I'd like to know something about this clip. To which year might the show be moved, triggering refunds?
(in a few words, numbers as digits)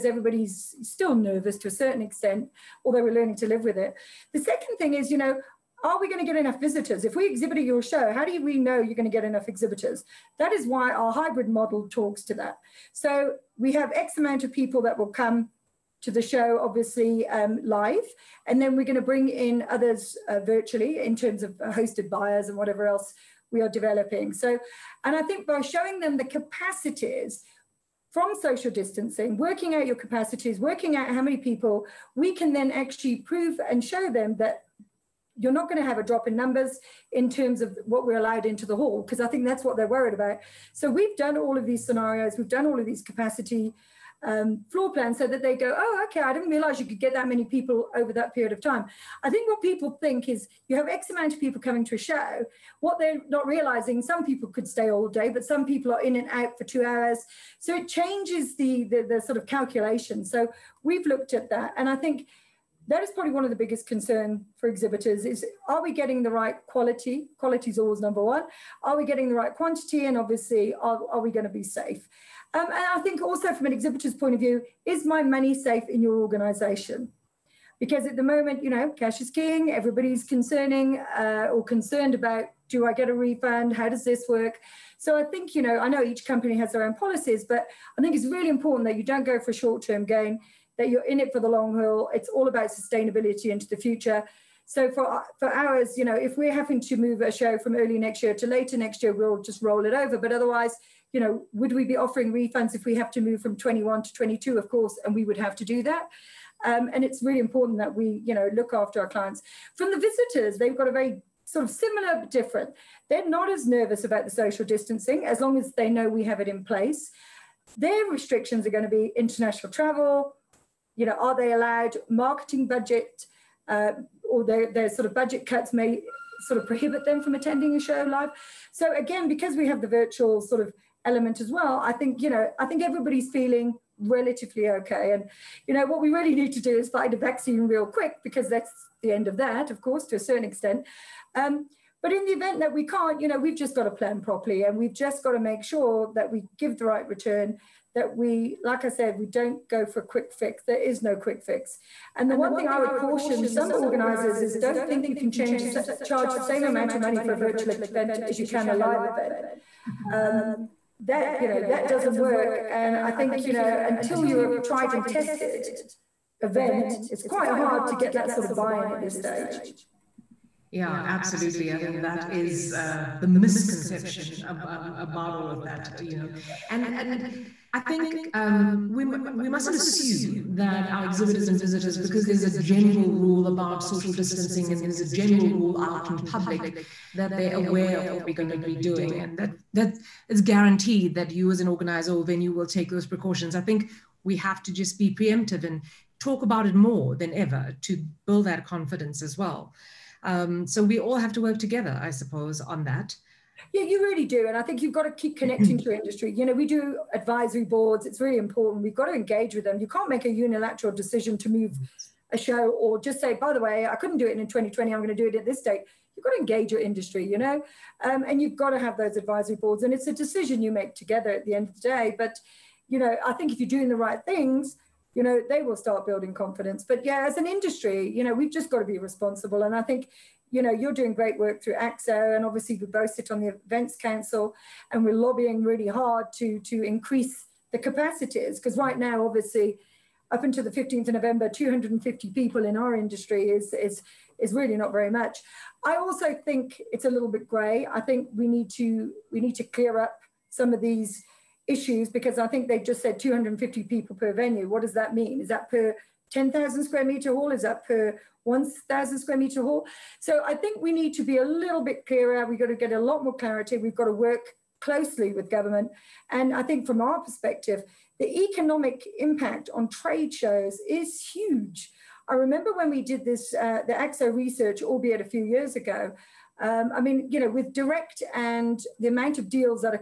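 22.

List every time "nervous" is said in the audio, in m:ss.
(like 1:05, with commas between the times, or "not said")
0:01, 1:53.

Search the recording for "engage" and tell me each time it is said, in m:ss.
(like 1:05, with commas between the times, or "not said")
3:29, 3:36.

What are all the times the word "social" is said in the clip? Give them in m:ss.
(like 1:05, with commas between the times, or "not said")
0:28, 1:54, 3:03.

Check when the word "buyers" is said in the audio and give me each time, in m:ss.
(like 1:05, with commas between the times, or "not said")
0:22.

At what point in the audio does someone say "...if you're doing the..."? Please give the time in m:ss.
3:43.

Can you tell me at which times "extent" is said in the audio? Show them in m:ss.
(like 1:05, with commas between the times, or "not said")
0:02, 2:20.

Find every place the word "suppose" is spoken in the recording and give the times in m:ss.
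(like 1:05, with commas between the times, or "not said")
3:22.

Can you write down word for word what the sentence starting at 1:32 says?
It's all about sustainability into the future.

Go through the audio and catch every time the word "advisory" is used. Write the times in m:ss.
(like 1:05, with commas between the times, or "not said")
3:27, 3:39.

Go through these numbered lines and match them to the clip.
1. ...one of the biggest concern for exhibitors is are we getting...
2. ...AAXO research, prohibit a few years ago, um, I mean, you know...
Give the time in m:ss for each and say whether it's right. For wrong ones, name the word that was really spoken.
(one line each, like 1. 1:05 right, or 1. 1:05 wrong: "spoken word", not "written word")
1. 1:03 right
2. 4:33 wrong: "albeit", not "prohibit".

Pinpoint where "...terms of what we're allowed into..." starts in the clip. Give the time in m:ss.
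0:37.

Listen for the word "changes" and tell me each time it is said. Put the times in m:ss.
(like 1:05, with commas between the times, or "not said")
0:57, 2:35.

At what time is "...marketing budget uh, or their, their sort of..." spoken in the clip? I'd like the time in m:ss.
2:02.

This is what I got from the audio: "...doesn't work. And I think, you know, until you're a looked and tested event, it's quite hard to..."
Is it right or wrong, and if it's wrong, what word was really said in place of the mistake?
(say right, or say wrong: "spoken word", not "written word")
wrong: "tried", not "looked".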